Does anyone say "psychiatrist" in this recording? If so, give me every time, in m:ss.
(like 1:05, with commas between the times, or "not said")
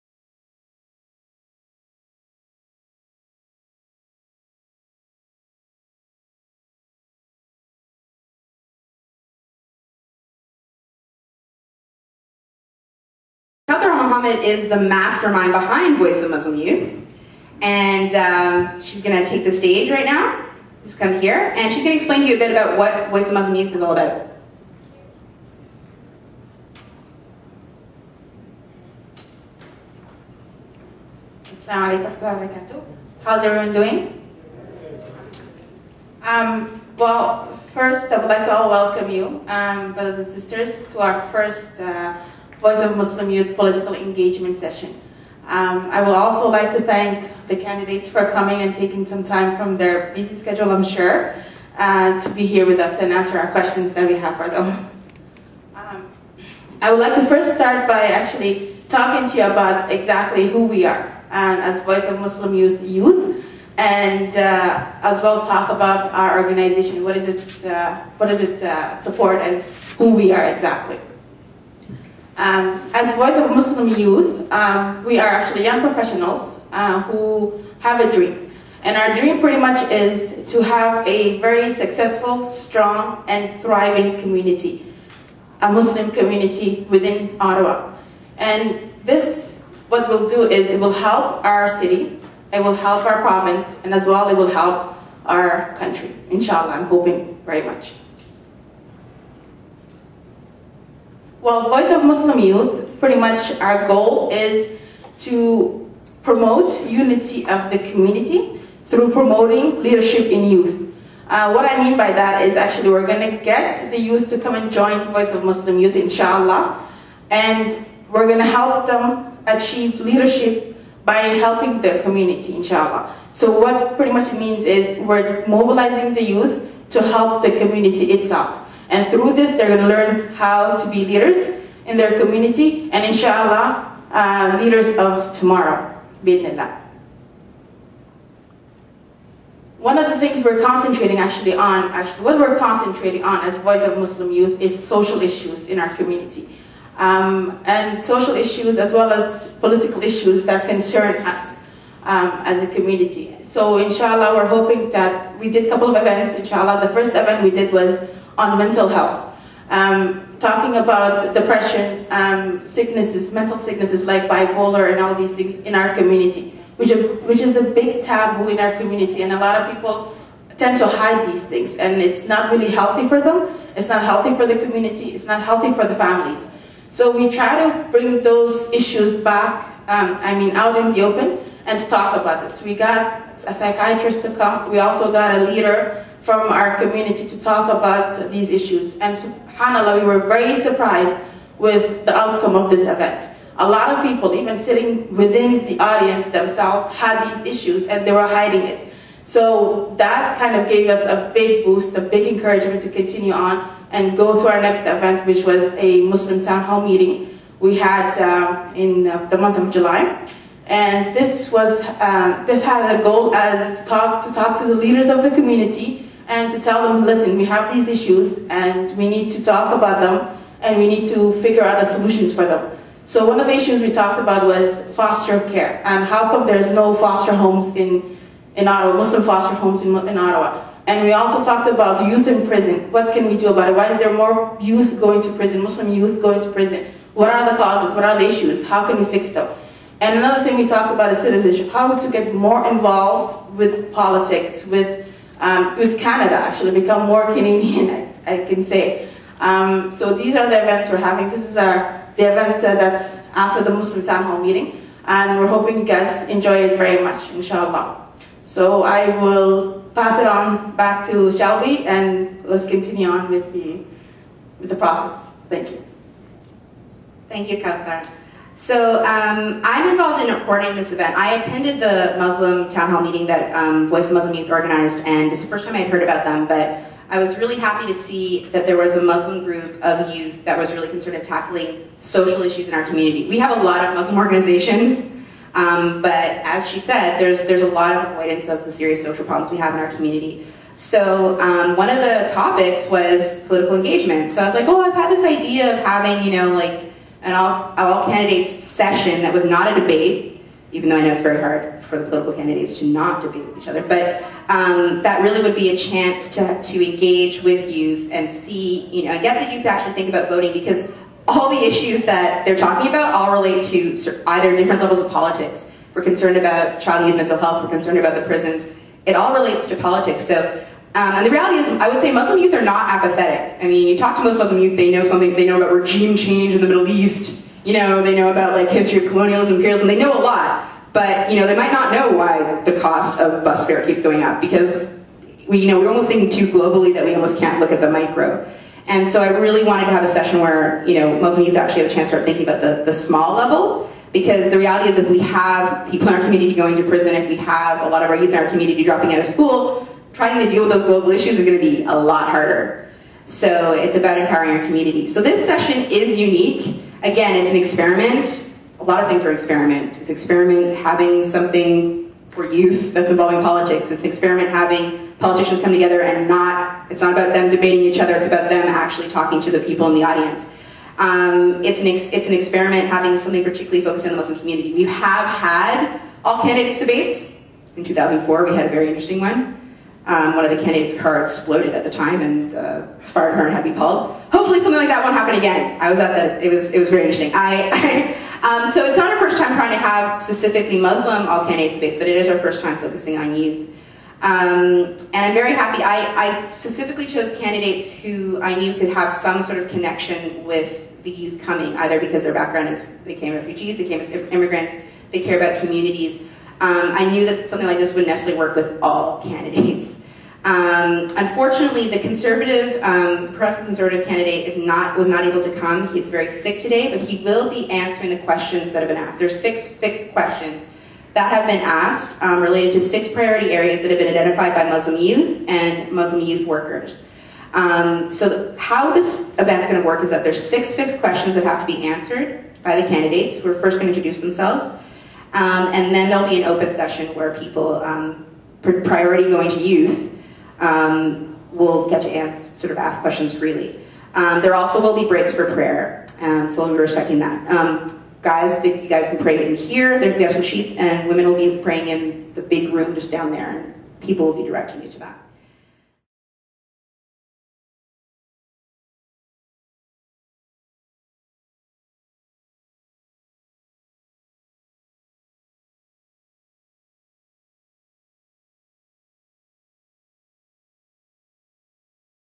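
3:03.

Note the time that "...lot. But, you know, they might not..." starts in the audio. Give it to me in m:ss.
5:30.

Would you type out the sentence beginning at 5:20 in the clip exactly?
So um, and the reality is, I would say Muslim youth are not apathetic.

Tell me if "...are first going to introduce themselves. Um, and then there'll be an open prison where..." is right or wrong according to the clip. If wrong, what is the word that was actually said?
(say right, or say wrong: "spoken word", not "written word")
wrong: "session", not "prison".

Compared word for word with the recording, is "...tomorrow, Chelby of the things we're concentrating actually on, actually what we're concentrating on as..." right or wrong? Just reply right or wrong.
wrong.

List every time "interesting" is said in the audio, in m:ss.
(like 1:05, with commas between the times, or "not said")
6:18, 6:27.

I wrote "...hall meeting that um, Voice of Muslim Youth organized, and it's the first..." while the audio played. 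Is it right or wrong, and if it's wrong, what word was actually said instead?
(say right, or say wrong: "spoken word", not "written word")
right.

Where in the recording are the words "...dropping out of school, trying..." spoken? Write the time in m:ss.
5:48.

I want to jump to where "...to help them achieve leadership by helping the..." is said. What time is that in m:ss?
1:58.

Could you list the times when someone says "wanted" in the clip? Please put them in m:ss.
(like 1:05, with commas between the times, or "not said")
5:39.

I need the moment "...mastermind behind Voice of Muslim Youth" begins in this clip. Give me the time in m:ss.
0:14.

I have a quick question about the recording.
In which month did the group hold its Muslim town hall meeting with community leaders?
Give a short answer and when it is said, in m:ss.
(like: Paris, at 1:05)
July, at 3:29.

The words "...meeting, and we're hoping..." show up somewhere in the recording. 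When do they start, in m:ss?
4:14.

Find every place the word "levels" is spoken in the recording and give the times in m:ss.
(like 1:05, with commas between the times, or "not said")
5:14, 5:43.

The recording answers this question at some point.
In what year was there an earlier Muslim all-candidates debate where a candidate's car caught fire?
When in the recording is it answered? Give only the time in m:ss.
6:17.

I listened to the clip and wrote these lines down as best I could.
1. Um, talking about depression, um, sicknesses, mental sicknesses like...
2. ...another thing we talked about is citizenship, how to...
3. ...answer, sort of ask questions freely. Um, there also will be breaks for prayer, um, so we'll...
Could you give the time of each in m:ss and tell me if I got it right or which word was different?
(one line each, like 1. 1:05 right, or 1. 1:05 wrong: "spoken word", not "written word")
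1. 2:39 right
2. 4:00 right
3. 7:22 right.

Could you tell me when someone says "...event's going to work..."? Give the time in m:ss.
7:09.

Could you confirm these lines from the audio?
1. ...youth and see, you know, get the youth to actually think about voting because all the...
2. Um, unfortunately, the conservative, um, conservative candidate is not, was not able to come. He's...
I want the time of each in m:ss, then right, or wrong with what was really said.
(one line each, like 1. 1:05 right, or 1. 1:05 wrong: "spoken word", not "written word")
1. 5:07 right
2. 6:50 right.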